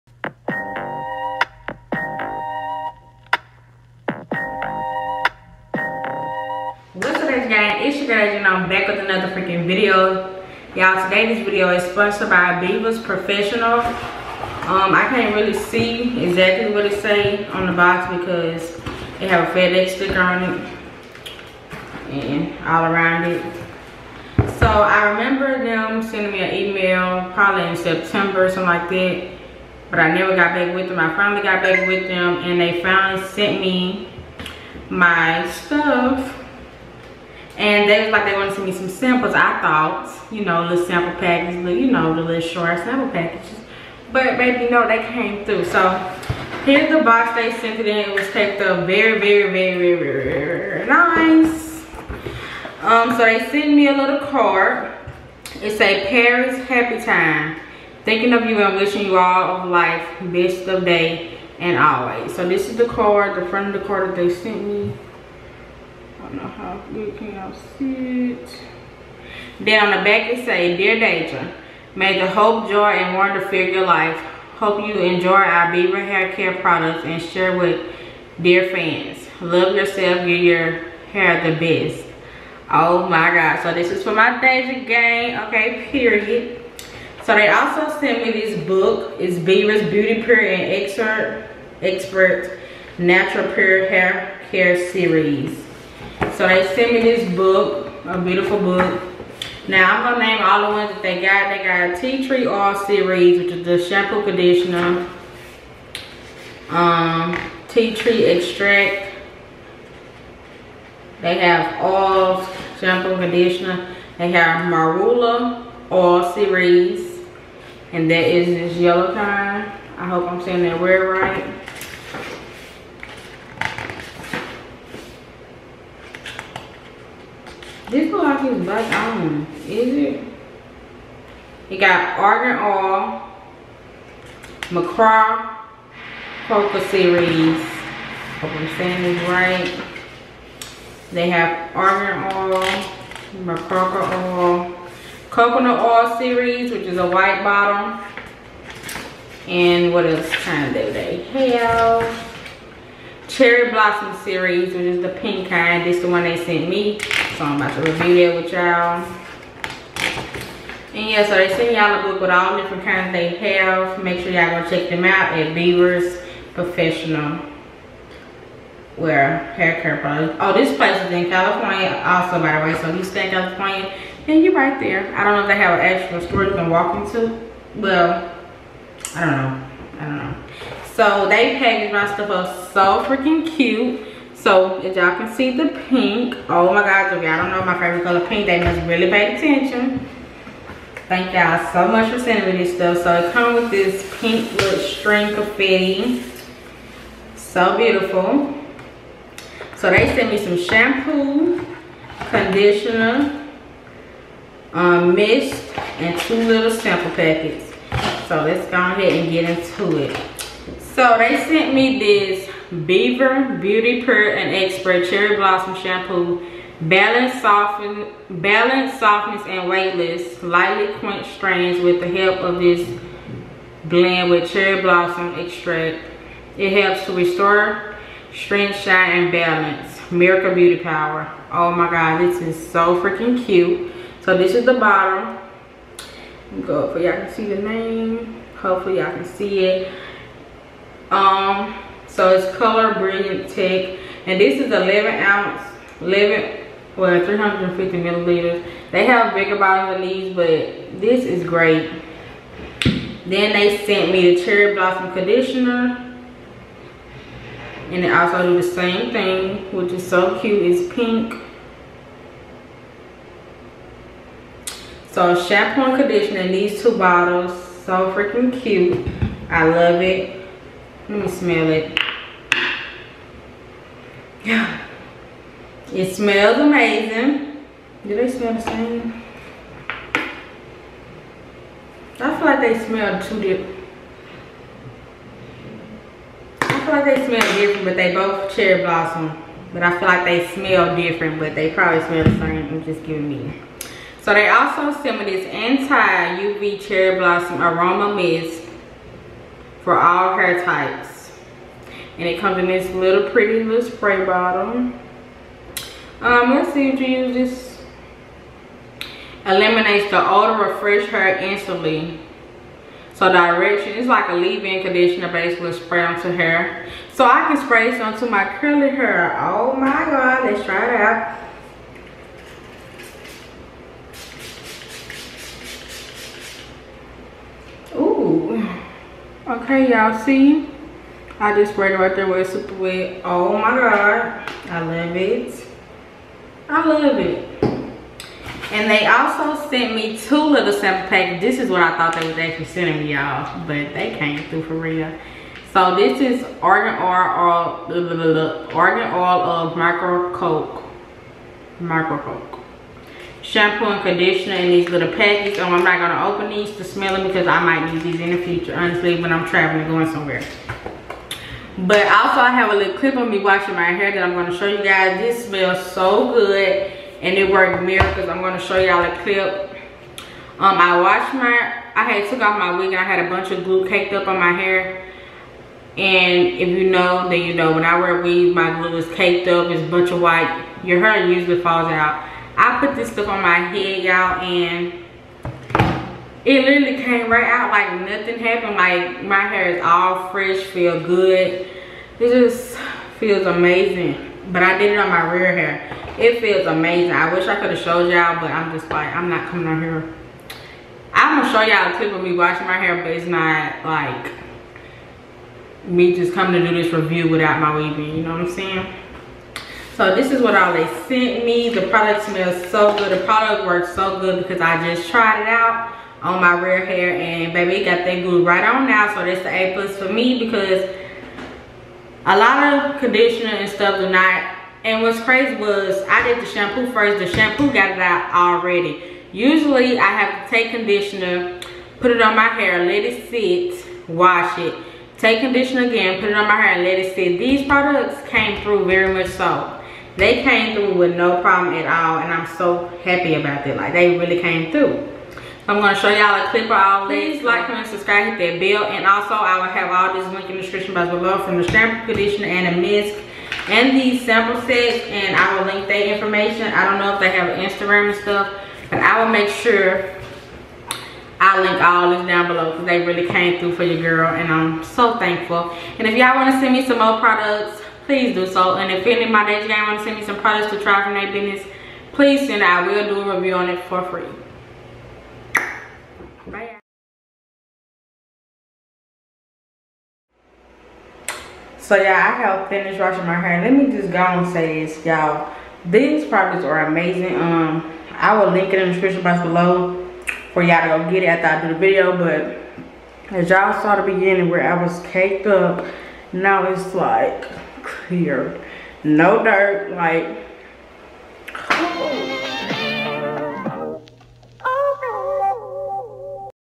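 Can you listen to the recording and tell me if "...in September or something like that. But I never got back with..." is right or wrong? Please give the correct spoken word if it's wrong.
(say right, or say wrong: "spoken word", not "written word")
right.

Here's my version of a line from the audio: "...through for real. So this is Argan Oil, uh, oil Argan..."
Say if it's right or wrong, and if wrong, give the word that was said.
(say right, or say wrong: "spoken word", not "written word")
right.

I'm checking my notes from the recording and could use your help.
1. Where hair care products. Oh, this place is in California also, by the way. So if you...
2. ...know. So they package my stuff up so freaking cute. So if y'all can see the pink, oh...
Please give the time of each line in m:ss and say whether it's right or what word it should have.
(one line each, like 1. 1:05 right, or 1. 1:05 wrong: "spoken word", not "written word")
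1. 2:48 right
2. 3:00 right.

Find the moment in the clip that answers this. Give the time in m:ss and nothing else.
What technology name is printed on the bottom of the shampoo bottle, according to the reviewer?
4:02.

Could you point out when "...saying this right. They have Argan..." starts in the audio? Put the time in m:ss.
2:18.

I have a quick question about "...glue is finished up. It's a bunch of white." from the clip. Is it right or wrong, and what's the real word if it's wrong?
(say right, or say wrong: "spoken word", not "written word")
wrong: "caked", not "finished".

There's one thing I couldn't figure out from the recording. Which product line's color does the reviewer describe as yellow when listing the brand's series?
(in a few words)
Marula.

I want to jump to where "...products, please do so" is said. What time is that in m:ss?
7:47.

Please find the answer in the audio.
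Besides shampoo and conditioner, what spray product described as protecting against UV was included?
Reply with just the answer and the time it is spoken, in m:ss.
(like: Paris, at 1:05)
Aroma mist, at 4:57.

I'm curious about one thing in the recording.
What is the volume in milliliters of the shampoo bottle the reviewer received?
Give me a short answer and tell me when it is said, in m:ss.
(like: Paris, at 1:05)
350 milliliters, at 4:07.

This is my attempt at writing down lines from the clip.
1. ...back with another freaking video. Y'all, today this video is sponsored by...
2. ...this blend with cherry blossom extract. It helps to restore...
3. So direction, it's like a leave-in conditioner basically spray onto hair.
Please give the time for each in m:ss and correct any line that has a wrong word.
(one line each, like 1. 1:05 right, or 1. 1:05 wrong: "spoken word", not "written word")
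1. 0:08 right
2. 3:42 right
3. 5:13 right.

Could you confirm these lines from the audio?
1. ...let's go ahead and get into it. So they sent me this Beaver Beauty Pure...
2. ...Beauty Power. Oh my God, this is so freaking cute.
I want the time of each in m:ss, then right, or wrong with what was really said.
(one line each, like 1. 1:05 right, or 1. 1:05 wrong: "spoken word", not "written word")
1. 3:28 right
2. 3:50 right.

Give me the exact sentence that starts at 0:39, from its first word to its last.
I thought, you know, little sample packages, but you know, the little short sample packages.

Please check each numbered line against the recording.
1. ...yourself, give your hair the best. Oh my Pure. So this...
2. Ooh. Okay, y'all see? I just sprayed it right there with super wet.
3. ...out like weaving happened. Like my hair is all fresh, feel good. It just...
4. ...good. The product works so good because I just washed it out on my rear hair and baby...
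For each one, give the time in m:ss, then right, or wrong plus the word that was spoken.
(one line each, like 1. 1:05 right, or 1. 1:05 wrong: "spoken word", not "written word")
1. 1:19 wrong: "God", not "Pure"
2. 5:27 right
3. 6:27 wrong: "nothing", not "weaving"
4. 6:52 wrong: "tried", not "washed".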